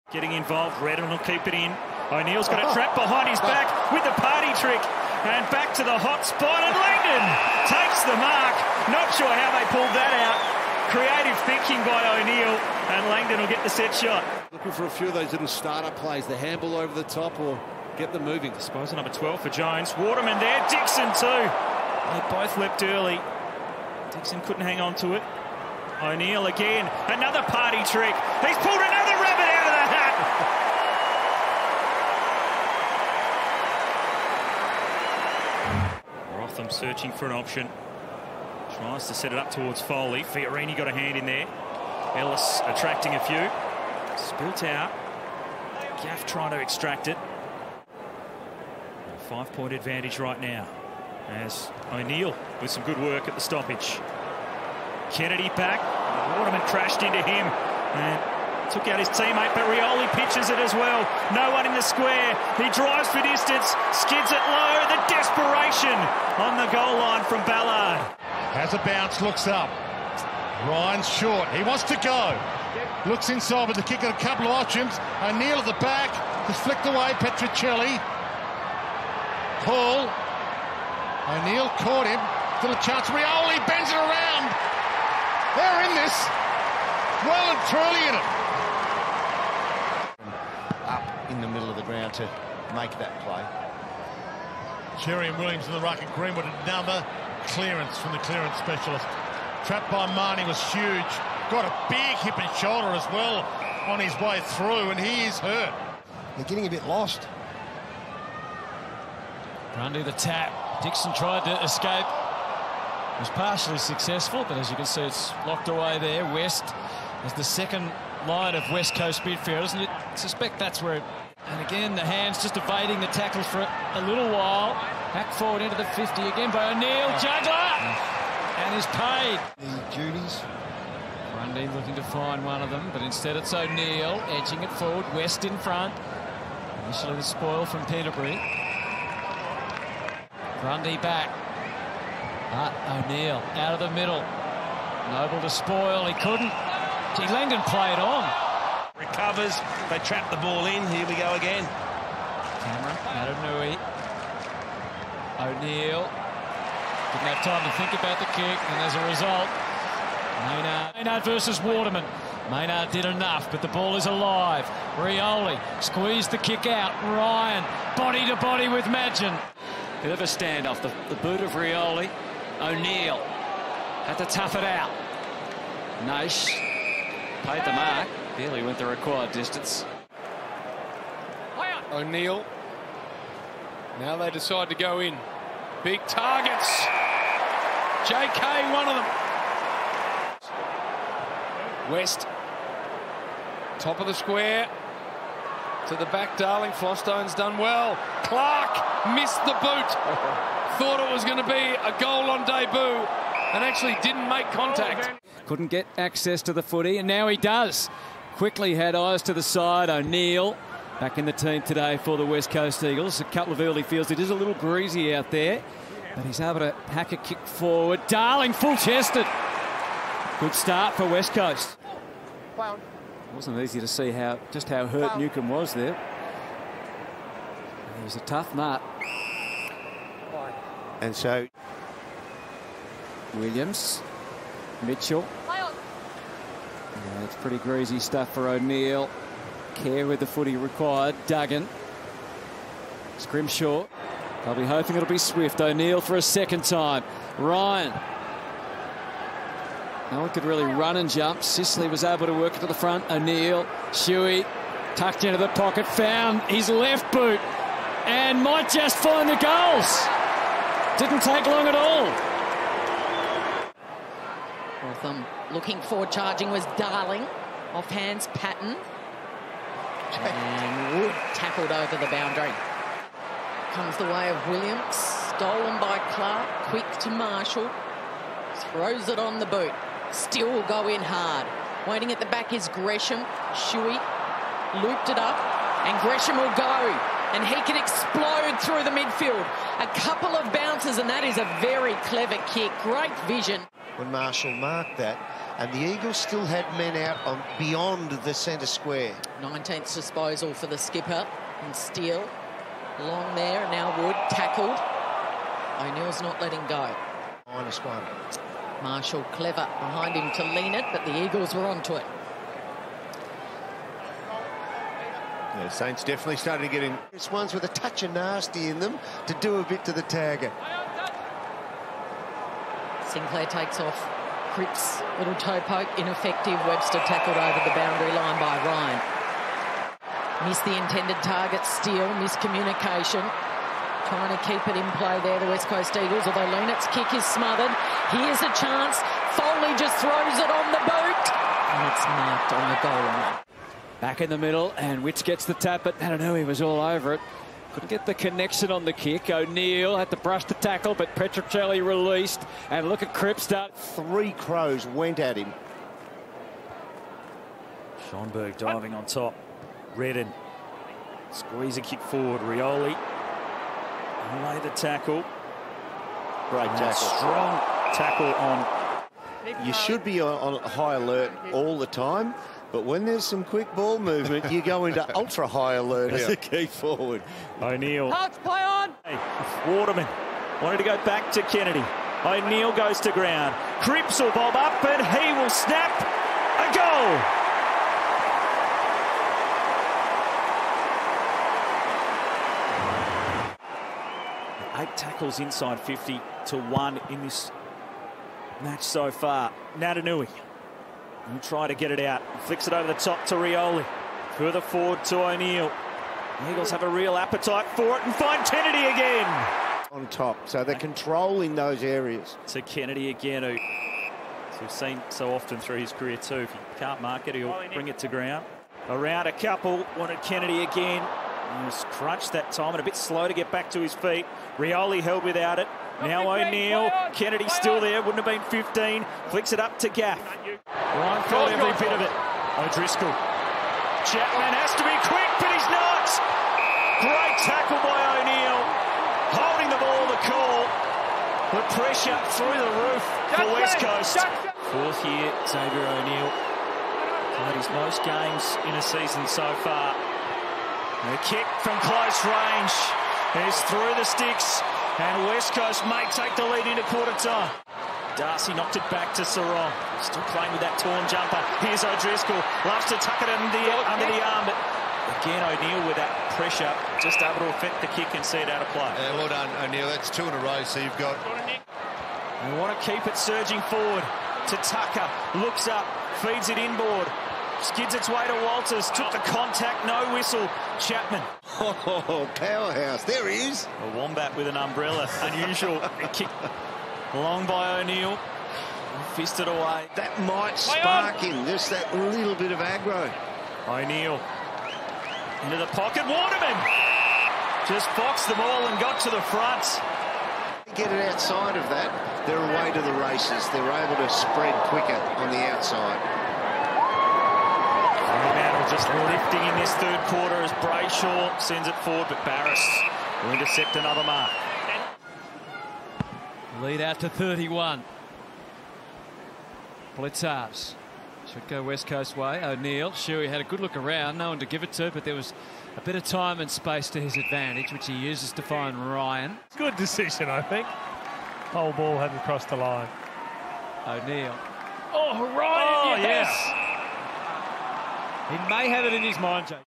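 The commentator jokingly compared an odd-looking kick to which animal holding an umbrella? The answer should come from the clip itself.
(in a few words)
wombat.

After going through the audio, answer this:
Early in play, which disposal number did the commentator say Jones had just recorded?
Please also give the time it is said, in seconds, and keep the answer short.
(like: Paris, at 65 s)
12, at 18 s.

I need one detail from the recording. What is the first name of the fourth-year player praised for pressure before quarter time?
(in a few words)
Xavier.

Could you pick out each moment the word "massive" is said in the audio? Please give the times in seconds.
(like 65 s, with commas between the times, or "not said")
not said.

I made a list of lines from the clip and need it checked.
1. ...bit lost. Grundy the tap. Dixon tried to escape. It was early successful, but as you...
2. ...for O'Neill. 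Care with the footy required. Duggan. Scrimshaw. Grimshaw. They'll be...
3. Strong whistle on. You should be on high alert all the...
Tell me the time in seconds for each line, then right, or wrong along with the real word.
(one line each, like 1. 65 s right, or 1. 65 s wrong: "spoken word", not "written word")
1. 106 s wrong: "partially", not "early"
2. 238 s right
3. 366 s wrong: "tackle", not "whistle".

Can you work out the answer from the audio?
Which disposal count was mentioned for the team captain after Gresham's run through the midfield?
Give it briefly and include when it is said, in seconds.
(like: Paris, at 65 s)
19th, at 299 s.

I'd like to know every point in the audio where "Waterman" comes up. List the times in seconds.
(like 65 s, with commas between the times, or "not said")
19 s, 56 s, 161 s, 379 s, 496 s.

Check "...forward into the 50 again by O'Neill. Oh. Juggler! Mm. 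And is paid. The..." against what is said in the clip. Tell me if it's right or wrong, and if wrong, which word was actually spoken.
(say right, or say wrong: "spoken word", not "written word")
right.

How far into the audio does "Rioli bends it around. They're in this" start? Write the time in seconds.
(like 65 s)
83 s.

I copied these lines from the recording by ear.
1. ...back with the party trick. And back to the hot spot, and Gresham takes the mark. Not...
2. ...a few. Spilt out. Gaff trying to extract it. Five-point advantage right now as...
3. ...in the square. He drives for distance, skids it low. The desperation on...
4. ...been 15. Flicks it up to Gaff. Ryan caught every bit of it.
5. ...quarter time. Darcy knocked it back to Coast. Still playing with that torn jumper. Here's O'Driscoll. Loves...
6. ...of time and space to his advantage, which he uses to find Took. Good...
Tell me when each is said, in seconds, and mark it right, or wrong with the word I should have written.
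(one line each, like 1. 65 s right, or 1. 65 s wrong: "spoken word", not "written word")
1. 3 s wrong: "Langdon", not "Gresham"
2. 43 s right
3. 61 s right
4. 428 s right
5. 456 s wrong: "Serong", not "Coast"
6. 525 s wrong: "Ryan", not "Took".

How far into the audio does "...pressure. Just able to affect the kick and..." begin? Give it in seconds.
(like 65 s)
466 s.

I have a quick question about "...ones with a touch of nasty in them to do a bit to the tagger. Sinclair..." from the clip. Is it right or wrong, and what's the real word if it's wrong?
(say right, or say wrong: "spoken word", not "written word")
right.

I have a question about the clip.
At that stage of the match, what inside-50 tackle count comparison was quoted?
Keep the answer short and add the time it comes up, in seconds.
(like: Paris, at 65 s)
8 to 1, at 394 s.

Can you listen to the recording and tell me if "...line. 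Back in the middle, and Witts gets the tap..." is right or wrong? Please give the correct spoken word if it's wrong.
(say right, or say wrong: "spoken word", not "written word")
right.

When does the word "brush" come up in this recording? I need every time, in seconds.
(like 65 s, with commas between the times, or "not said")
350 s.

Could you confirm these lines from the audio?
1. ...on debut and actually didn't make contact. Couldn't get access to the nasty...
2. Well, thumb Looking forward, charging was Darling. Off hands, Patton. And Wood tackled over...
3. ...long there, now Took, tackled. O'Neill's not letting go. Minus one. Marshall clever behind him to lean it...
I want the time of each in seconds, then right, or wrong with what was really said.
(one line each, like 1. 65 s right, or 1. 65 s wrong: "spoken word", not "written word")
1. 202 s wrong: "footy", not "nasty"
2. 264 s right
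3. 302 s wrong: "Wood", not "Took".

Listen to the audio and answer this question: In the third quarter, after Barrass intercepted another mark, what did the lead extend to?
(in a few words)
31.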